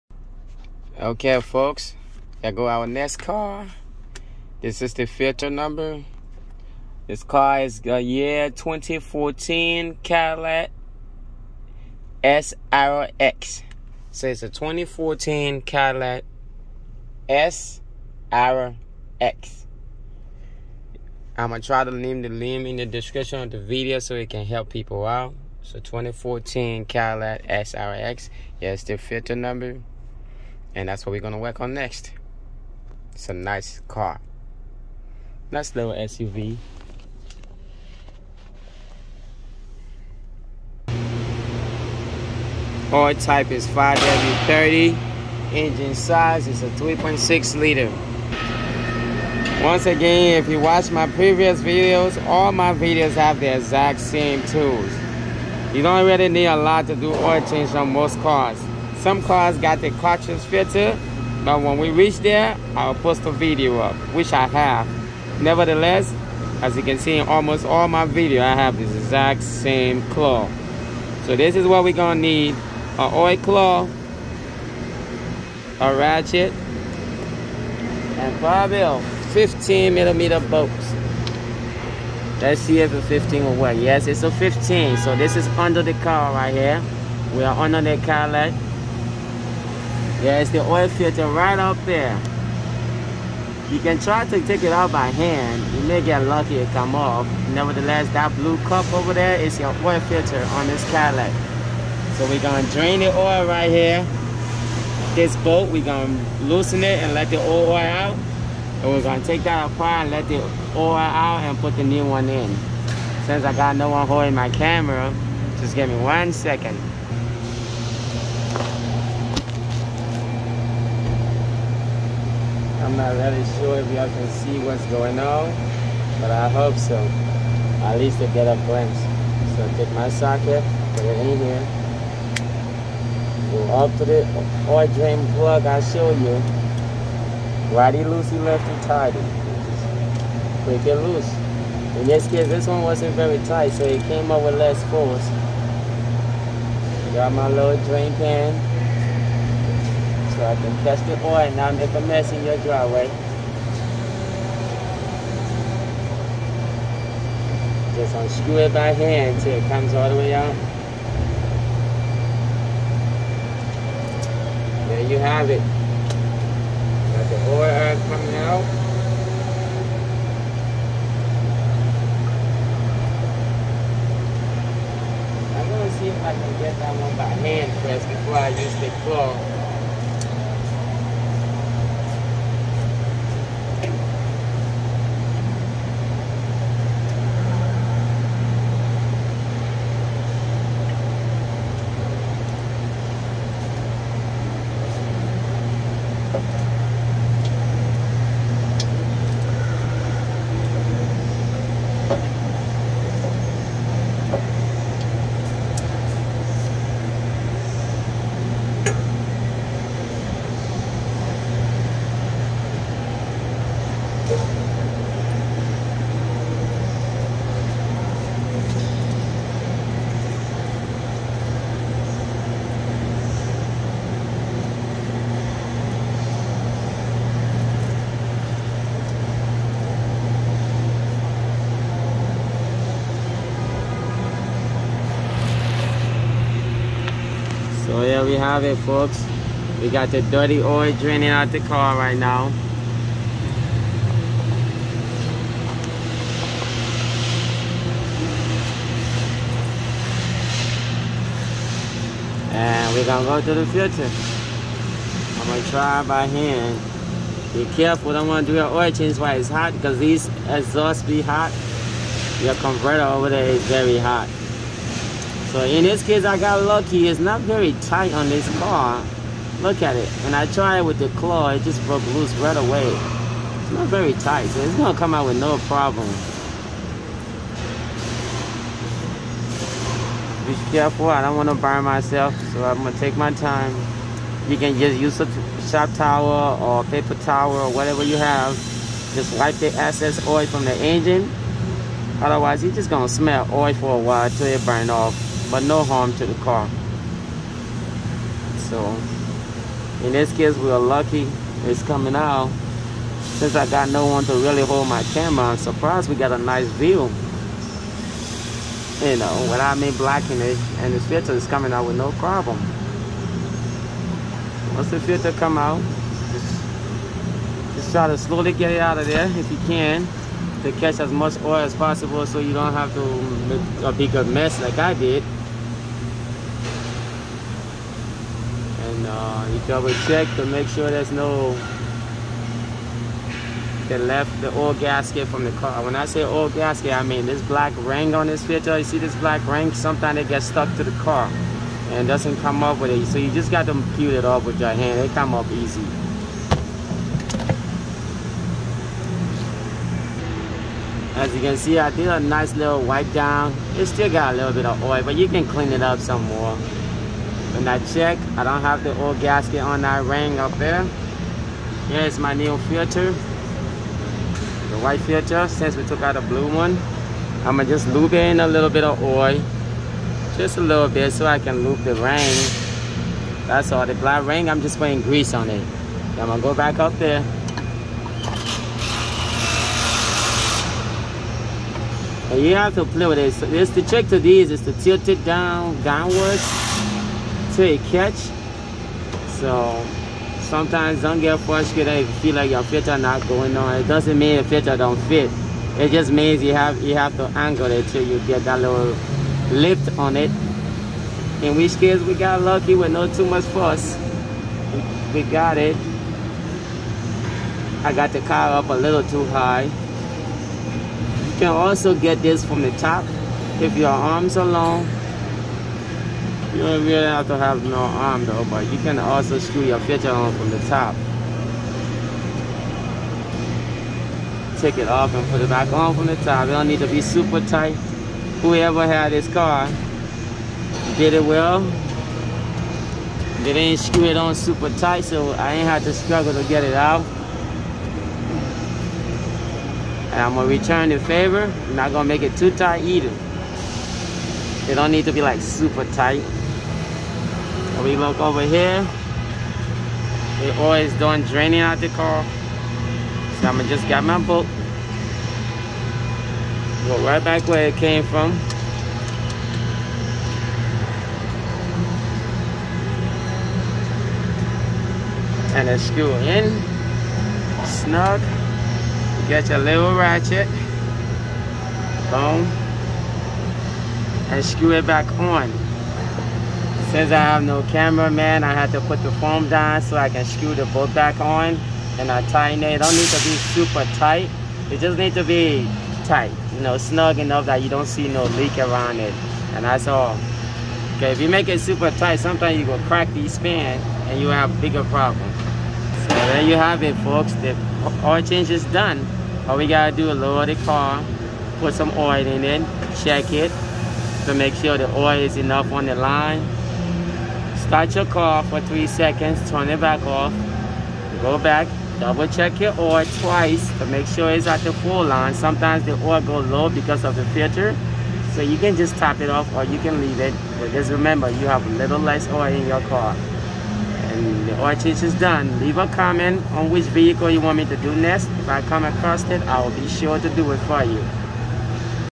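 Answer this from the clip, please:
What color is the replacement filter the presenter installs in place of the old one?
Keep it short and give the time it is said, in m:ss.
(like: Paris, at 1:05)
White, at 6:04.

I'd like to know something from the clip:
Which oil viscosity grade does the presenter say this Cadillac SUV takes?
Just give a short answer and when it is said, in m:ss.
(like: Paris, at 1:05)
5W30, at 0:43.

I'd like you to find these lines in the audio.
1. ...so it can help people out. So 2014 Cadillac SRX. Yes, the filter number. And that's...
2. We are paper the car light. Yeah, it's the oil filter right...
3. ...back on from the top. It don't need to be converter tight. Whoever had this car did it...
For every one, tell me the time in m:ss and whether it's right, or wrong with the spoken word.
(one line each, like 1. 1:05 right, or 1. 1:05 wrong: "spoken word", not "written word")
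1. 0:23 right
2. 1:27 wrong: "under", not "paper"
3. 7:05 wrong: "super", not "converter".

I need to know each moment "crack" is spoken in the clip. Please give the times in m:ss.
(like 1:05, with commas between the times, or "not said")
8:12.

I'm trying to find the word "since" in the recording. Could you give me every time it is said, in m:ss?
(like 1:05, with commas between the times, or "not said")
1:53, 5:03, 6:05, 7:56.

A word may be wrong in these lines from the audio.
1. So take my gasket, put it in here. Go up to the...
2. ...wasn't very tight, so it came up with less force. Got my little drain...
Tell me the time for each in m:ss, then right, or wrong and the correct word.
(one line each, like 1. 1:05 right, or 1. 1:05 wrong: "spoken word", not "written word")
1. 2:09 wrong: "socket", not "gasket"
2. 2:22 right.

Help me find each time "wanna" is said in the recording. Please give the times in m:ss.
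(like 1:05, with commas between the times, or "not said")
4:18, 4:41.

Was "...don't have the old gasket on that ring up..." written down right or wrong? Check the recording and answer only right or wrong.
right.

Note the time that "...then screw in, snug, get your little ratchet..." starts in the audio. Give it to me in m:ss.
7:45.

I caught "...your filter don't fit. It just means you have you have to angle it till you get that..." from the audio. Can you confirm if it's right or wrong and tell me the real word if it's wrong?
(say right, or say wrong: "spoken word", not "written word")
right.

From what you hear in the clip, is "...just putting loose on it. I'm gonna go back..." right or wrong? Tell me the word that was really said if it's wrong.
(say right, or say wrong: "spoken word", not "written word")
wrong: "grease", not "loose".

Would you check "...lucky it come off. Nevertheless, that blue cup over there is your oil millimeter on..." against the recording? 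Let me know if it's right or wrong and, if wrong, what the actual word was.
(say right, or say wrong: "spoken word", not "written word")
wrong: "filter", not "millimeter".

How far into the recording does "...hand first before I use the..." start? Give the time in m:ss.
2:57.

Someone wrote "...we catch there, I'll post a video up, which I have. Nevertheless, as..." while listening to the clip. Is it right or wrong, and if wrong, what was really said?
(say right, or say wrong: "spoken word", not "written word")
wrong: "reach", not "catch".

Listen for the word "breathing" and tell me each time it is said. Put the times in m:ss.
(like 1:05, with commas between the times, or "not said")
not said.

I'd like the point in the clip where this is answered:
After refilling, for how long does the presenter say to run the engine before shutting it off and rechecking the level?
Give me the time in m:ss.
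8:28.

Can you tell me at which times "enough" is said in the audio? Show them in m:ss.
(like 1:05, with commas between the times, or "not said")
8:07, 8:25.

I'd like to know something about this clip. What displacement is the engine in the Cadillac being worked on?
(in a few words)
3.6 liter.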